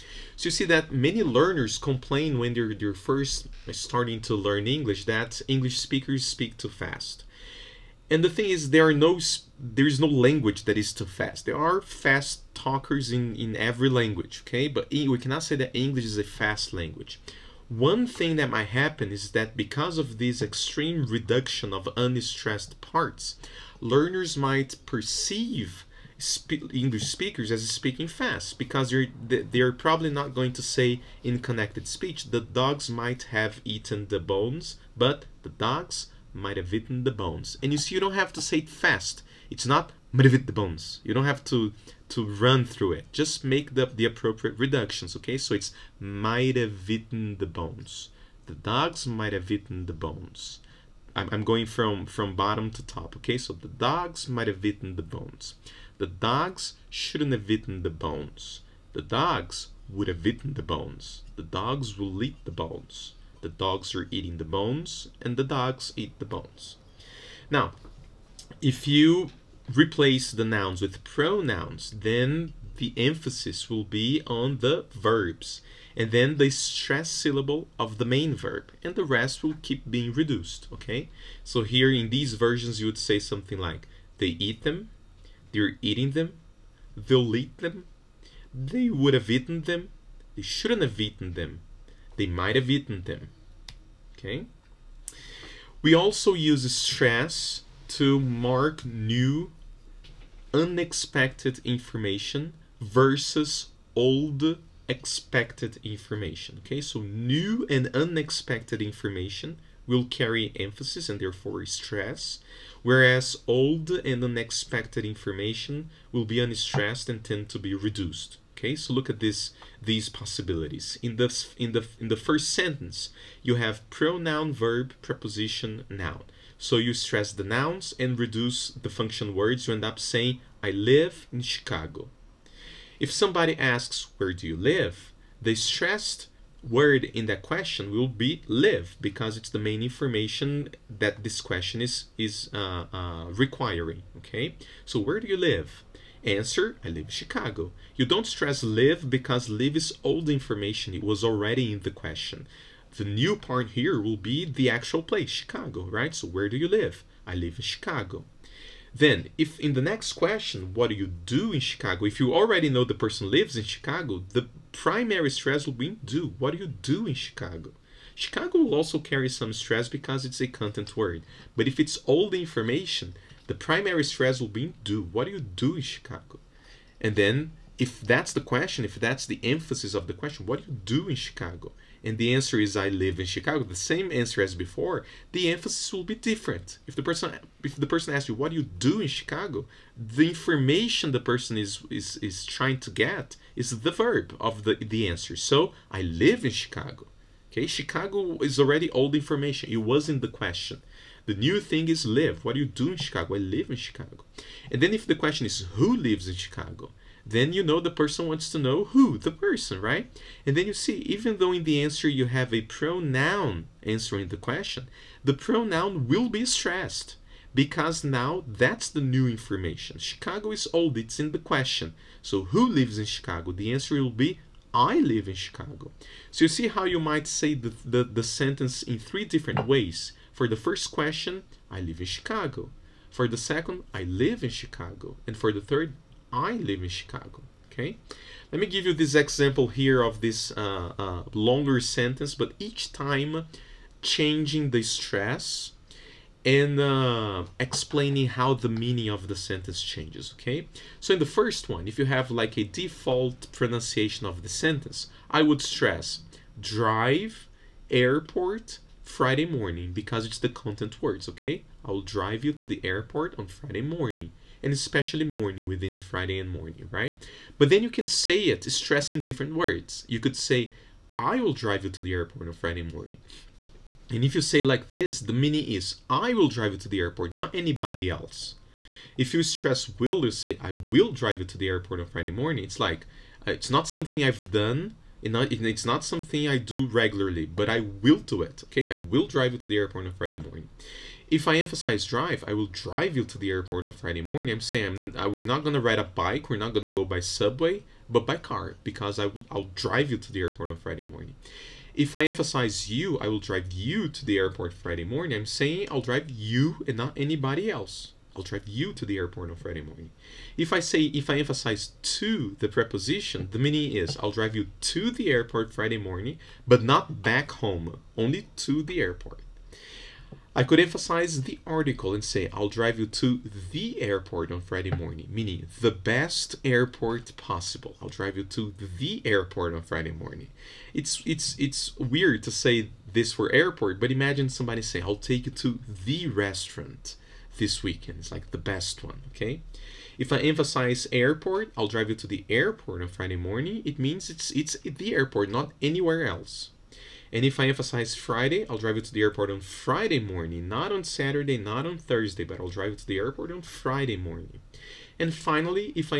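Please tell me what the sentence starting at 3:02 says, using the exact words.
and the answer is I live in Chicago, the same answer as before, the emphasis will be different.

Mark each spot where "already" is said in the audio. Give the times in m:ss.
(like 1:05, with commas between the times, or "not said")
2:31, 2:42, 3:18.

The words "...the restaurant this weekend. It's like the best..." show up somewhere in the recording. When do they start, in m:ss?
5:36.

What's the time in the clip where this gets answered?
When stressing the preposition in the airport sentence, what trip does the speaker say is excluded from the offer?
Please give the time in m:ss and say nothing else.
5:17.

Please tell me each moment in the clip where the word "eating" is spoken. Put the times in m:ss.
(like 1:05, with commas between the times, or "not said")
1:04, 1:25.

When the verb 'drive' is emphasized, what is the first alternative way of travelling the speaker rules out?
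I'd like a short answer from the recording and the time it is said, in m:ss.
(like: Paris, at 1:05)
bike, at 4:56.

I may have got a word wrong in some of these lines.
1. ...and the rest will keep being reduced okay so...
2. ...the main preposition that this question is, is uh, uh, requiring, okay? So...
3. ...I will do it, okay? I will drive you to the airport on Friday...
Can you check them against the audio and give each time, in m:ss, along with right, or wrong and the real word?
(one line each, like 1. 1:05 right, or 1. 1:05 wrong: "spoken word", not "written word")
1. 1:18 right
2. 2:19 wrong: "information", not "preposition"
3. 4:47 right.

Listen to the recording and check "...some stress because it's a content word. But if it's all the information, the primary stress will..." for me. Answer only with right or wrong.
right.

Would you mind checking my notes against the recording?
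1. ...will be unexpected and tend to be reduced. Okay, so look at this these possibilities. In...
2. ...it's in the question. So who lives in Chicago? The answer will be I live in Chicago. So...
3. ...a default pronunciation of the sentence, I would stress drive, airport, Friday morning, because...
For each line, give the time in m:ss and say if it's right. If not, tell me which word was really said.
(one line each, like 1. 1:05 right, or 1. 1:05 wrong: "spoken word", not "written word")
1. 1:56 wrong: "unstressed", not "unexpected"
2. 3:40 right
3. 4:12 right.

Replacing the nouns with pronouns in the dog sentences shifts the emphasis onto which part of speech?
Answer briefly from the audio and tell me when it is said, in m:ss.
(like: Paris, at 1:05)
verbs, at 1:14.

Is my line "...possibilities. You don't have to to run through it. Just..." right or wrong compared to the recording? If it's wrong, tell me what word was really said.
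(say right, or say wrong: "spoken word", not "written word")
wrong: "bones", not "possibilities".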